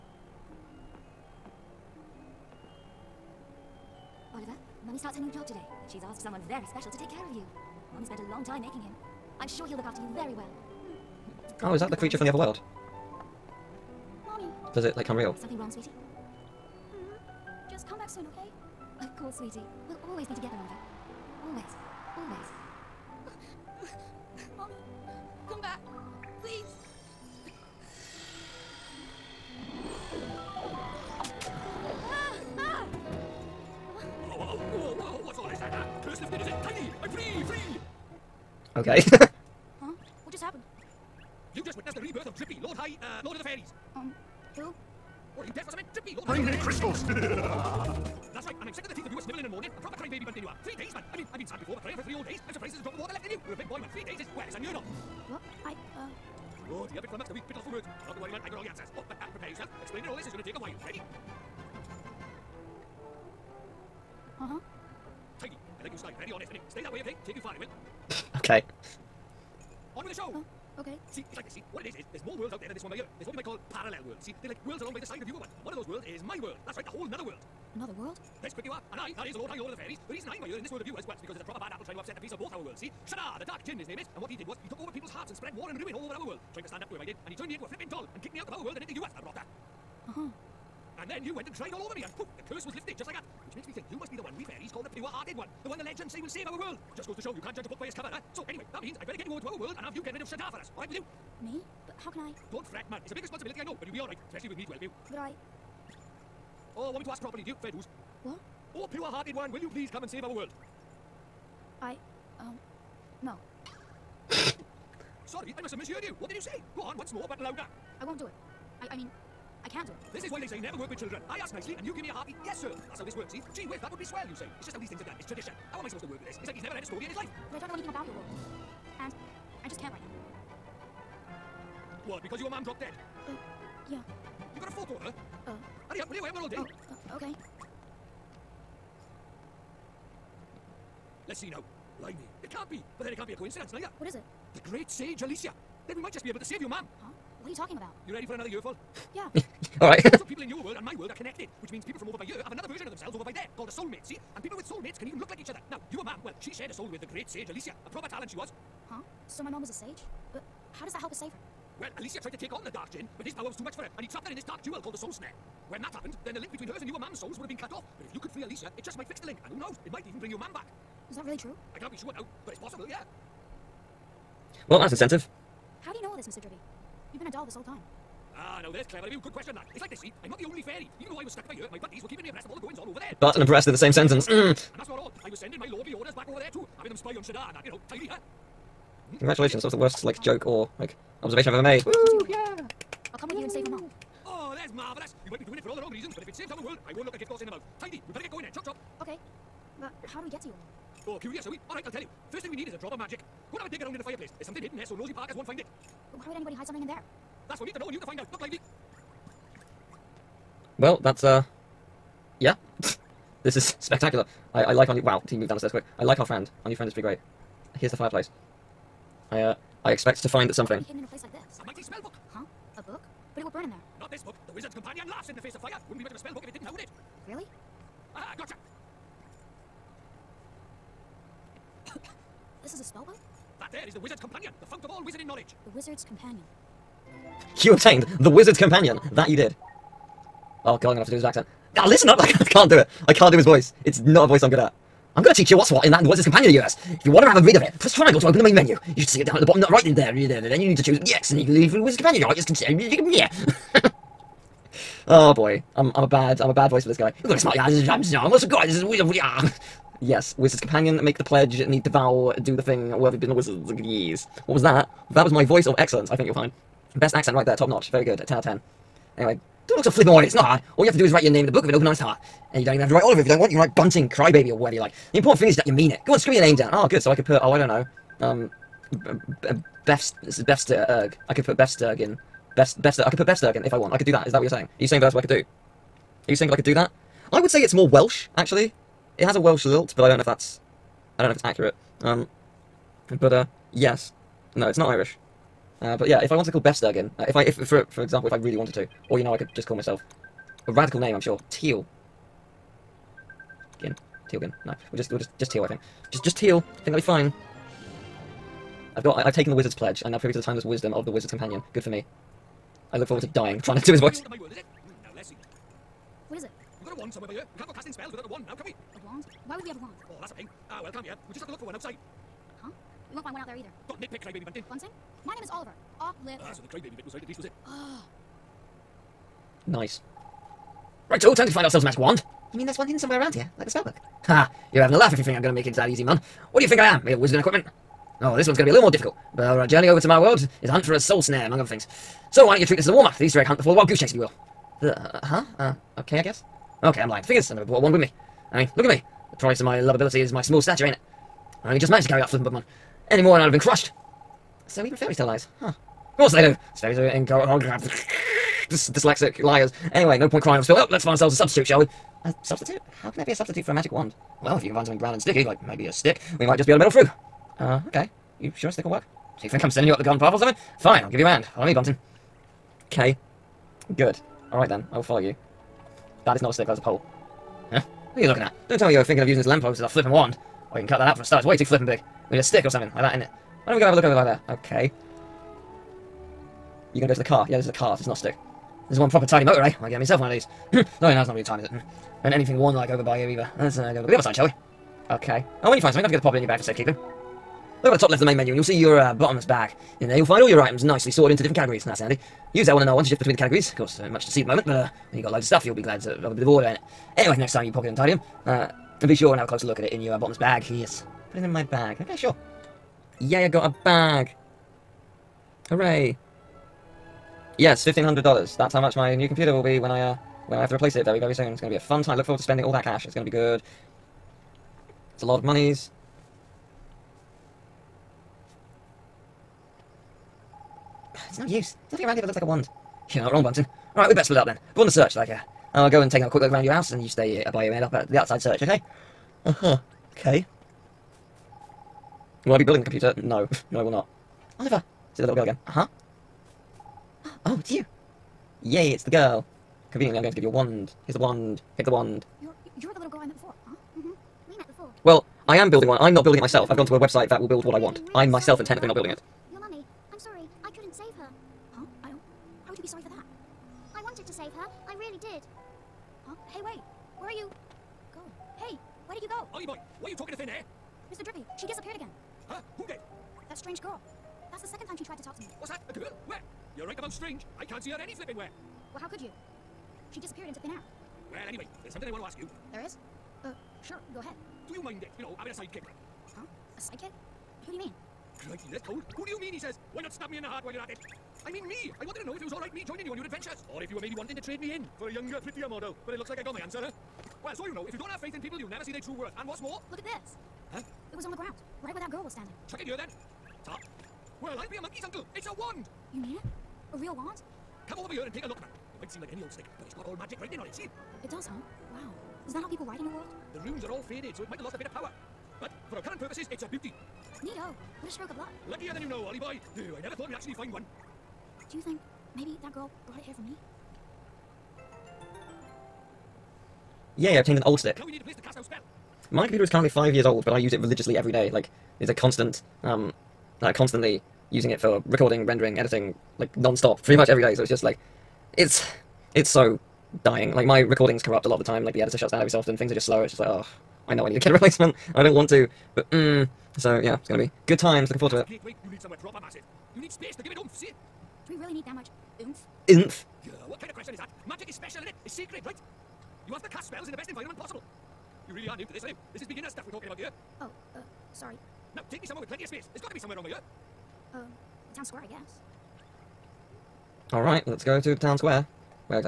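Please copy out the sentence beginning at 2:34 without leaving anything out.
And people with soulmates can even look like each other.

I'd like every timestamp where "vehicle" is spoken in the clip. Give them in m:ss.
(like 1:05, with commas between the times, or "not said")
not said.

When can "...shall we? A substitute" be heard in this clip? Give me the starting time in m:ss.
6:01.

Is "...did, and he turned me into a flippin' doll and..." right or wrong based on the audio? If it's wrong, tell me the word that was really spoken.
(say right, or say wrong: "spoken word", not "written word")
right.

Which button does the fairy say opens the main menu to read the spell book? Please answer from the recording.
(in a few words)
Triangle.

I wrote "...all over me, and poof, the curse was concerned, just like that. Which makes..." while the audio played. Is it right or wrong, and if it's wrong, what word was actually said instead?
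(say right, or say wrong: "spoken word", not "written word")
wrong: "lifted", not "concerned".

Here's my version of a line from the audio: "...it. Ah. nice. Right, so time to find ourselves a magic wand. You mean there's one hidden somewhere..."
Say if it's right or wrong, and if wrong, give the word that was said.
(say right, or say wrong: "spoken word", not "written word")
right.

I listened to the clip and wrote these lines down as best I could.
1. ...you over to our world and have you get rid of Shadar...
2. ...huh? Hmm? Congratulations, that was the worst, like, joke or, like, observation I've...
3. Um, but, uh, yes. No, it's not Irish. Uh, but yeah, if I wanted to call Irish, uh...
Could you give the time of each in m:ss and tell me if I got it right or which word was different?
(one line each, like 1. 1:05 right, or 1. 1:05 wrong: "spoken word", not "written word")
1. 1:39 right
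2. 3:08 right
3. 4:52 wrong: "Befsturgen", not "Irish".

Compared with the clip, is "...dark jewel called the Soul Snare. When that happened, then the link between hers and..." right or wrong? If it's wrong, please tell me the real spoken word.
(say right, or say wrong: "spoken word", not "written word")
right.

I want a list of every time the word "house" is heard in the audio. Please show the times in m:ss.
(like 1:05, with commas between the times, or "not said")
7:16.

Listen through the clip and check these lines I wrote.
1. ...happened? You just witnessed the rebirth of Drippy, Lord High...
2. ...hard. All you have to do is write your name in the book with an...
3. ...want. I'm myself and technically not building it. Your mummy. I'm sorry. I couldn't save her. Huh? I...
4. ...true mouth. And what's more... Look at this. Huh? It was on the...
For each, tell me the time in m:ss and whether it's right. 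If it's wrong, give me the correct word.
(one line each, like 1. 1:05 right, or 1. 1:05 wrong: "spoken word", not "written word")
1. 0:40 right
2. 4:30 right
3. 7:37 right
4. 8:18 wrong: "worth", not "mouth".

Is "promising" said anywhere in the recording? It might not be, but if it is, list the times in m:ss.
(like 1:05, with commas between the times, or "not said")
not said.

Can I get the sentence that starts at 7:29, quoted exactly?
Conveniently, I'm going to give you a wand.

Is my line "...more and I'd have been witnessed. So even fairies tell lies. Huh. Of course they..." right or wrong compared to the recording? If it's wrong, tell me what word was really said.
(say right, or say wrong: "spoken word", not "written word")
wrong: "crushed", not "witnessed".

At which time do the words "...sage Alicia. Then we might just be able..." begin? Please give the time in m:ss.
2:24.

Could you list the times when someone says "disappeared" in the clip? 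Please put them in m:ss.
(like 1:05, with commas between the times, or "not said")
7:51, 8:00.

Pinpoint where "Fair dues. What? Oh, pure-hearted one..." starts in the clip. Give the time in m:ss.
1:47.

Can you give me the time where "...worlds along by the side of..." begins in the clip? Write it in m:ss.
1:14.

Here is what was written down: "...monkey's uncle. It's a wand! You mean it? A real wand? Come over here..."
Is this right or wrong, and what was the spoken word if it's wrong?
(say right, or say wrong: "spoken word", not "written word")
right.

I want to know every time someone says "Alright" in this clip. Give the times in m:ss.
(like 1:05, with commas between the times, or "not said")
6:14, 7:13, 9:27.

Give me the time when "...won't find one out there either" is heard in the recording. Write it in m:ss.
5:23.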